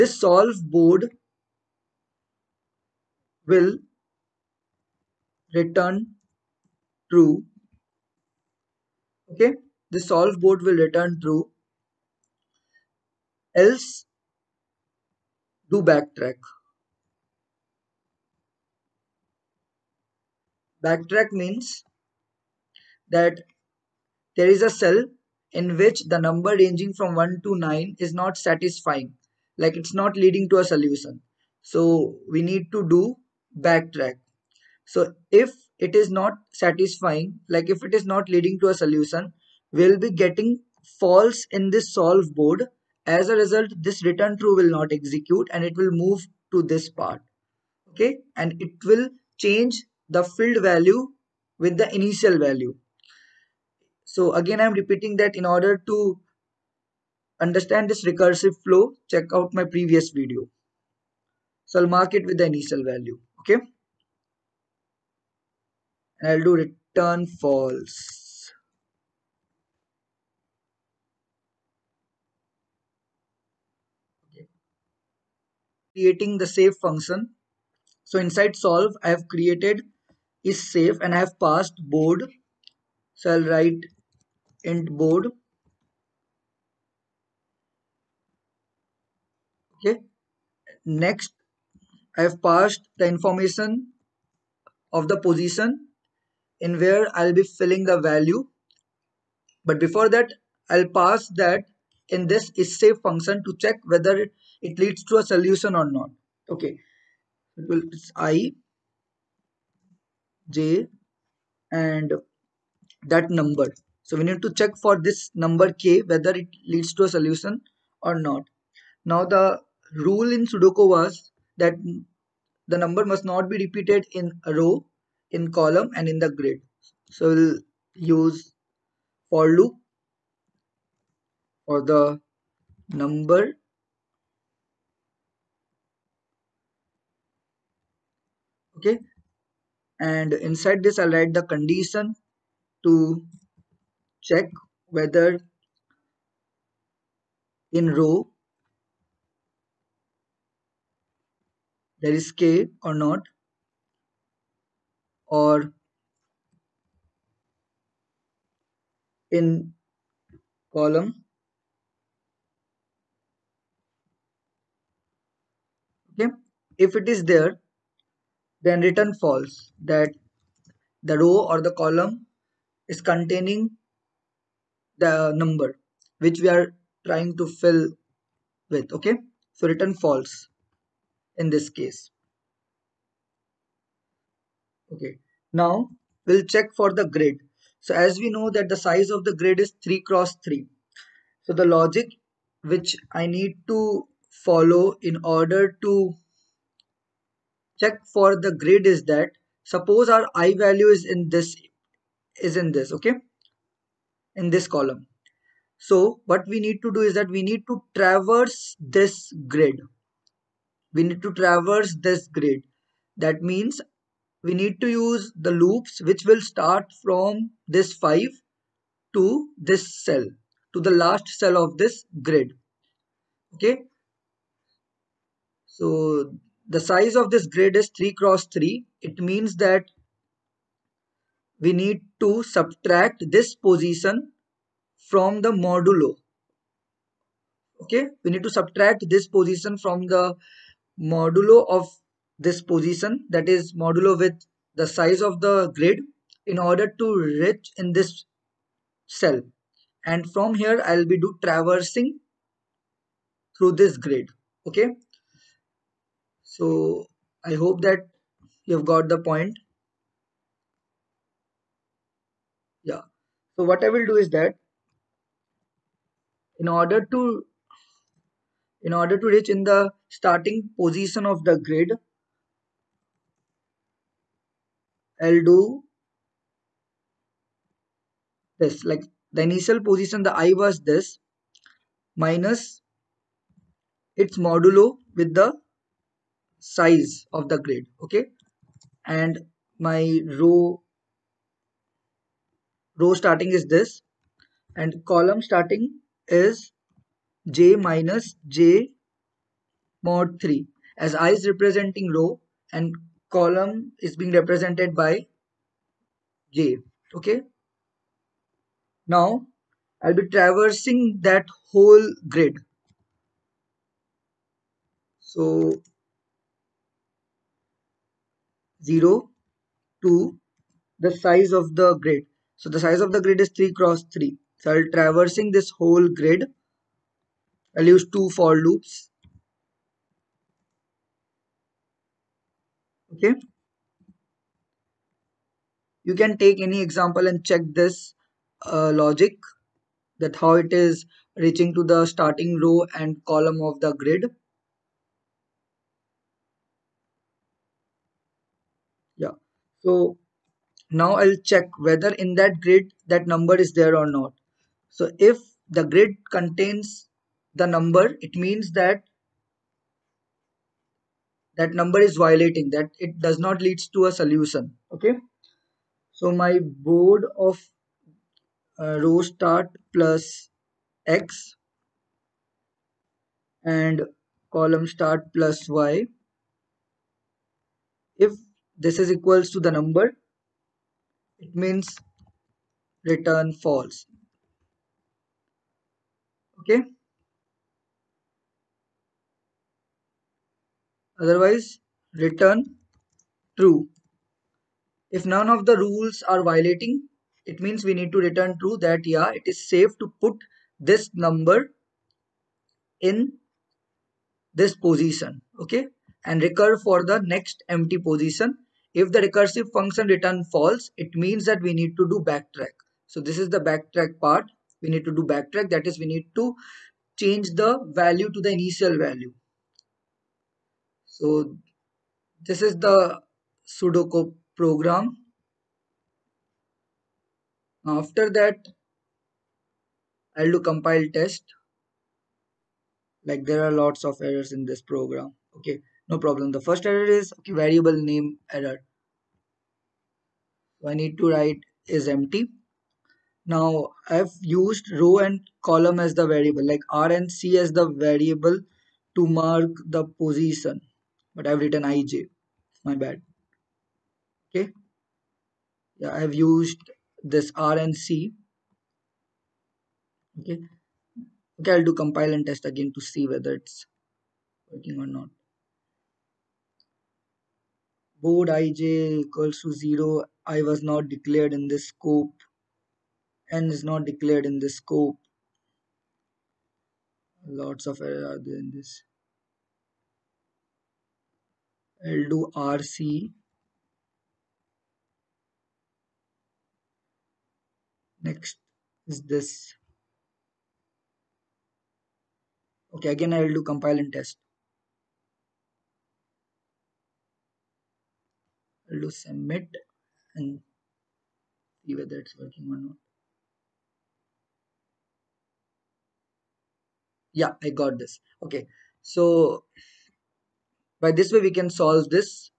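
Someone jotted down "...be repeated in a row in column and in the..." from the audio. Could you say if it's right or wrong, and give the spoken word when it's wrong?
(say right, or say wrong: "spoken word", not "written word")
right.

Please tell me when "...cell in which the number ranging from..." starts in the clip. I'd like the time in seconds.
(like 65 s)
24 s.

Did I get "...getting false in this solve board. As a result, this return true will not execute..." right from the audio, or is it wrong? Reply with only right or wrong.
right.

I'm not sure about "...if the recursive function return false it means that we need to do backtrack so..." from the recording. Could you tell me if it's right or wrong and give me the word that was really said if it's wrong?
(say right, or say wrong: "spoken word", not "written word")
right.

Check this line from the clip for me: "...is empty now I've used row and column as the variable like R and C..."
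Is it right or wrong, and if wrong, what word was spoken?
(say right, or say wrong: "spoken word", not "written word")
right.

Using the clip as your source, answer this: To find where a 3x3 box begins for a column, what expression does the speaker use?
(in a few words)
j - j mod 3.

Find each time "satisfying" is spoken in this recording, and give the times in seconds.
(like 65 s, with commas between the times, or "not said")
28 s, 36 s.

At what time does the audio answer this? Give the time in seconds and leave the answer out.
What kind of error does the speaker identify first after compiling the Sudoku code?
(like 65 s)
437 s.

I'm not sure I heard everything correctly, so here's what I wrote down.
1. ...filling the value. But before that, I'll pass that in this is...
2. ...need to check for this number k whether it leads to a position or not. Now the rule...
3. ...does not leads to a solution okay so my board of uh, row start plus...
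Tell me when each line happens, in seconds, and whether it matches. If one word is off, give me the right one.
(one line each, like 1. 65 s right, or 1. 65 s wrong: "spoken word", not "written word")
1. 97 s right
2. 114 s wrong: "solution", not "position"
3. 363 s right.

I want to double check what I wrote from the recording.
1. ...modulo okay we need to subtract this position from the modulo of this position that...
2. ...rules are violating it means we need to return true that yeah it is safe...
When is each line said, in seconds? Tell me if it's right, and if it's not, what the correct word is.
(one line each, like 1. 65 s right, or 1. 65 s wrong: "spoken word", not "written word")
1. 235 s right
2. 395 s right.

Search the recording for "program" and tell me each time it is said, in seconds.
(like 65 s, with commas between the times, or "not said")
424 s, 434 s.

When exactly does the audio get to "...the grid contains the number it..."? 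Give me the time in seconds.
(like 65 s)
355 s.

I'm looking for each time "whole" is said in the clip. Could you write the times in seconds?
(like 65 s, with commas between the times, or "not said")
311 s, 325 s.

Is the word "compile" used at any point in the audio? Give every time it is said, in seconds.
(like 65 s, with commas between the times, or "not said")
430 s, 461 s, 493 s.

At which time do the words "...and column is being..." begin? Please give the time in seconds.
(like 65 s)
302 s.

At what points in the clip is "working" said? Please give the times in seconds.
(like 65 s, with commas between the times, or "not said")
464 s, 502 s.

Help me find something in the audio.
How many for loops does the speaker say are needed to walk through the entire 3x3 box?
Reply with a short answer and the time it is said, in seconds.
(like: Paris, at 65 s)
2, at 328 s.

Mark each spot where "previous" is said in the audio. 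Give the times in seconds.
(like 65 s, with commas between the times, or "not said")
59 s.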